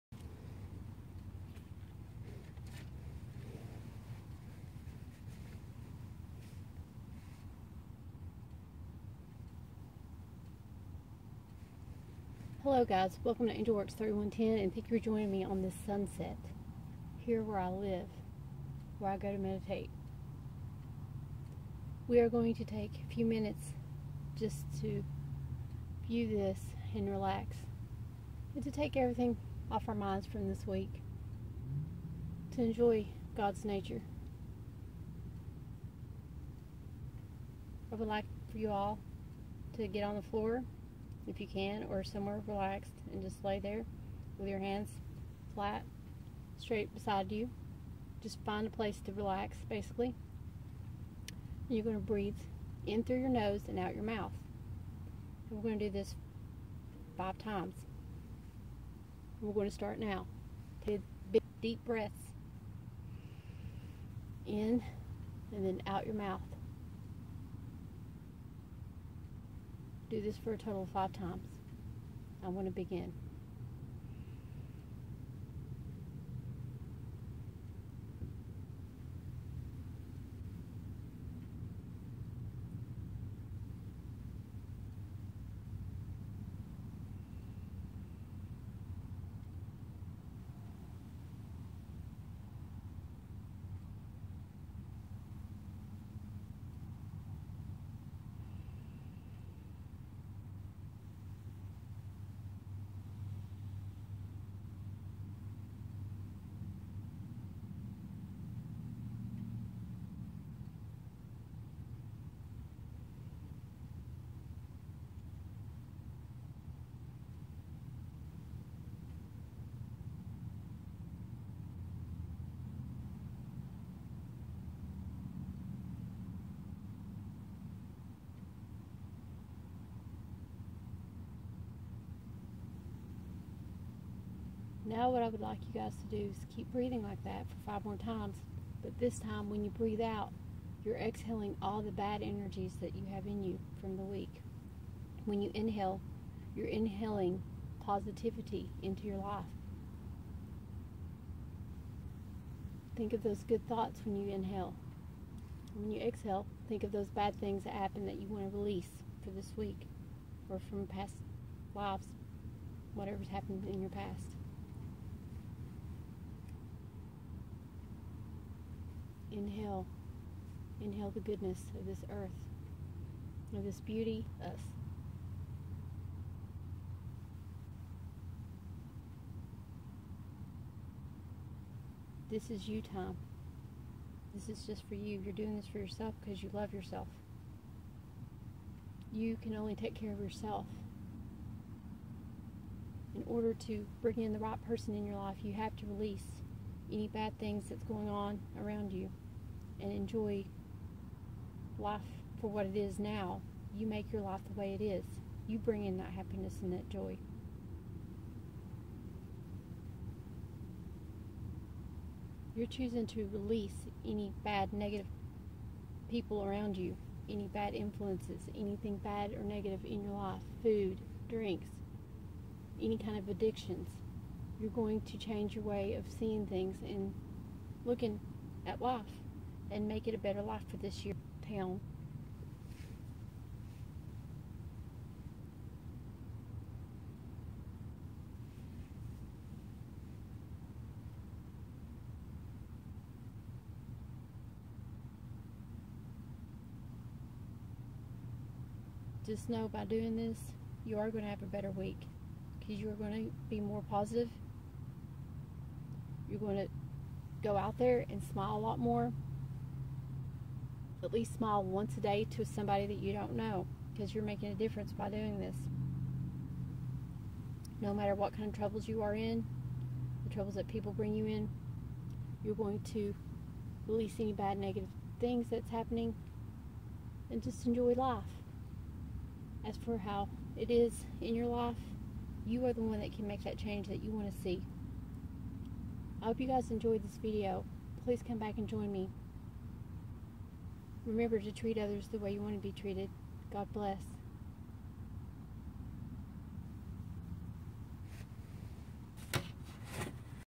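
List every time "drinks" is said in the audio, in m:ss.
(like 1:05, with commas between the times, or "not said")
3:41.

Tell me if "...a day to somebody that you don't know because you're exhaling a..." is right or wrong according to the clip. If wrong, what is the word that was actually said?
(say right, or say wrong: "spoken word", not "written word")
wrong: "making", not "exhaling".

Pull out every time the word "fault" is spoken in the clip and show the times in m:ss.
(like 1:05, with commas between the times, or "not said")
not said.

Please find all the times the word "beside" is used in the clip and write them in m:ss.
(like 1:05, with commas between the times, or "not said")
0:46.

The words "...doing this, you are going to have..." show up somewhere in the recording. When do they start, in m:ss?
4:09.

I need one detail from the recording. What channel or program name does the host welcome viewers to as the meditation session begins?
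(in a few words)
Angel Works 3110.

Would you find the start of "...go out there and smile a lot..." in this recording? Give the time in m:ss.
4:17.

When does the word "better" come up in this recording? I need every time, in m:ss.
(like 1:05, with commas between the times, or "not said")
3:50, 4:11.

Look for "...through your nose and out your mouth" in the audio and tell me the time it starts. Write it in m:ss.
0:53.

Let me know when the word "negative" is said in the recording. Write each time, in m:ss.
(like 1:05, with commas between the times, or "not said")
3:34, 3:39, 4:34.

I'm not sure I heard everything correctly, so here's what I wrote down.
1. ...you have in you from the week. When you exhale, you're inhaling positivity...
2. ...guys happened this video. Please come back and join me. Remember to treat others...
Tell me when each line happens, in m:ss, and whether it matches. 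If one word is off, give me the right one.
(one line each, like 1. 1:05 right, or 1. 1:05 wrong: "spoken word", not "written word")
1. 2:22 wrong: "inhale", not "exhale"
2. 4:46 wrong: "enjoyed", not "happened".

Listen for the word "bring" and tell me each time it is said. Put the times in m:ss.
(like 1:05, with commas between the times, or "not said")
3:14, 3:25, 4:30.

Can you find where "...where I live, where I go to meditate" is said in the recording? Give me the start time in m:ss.
0:17.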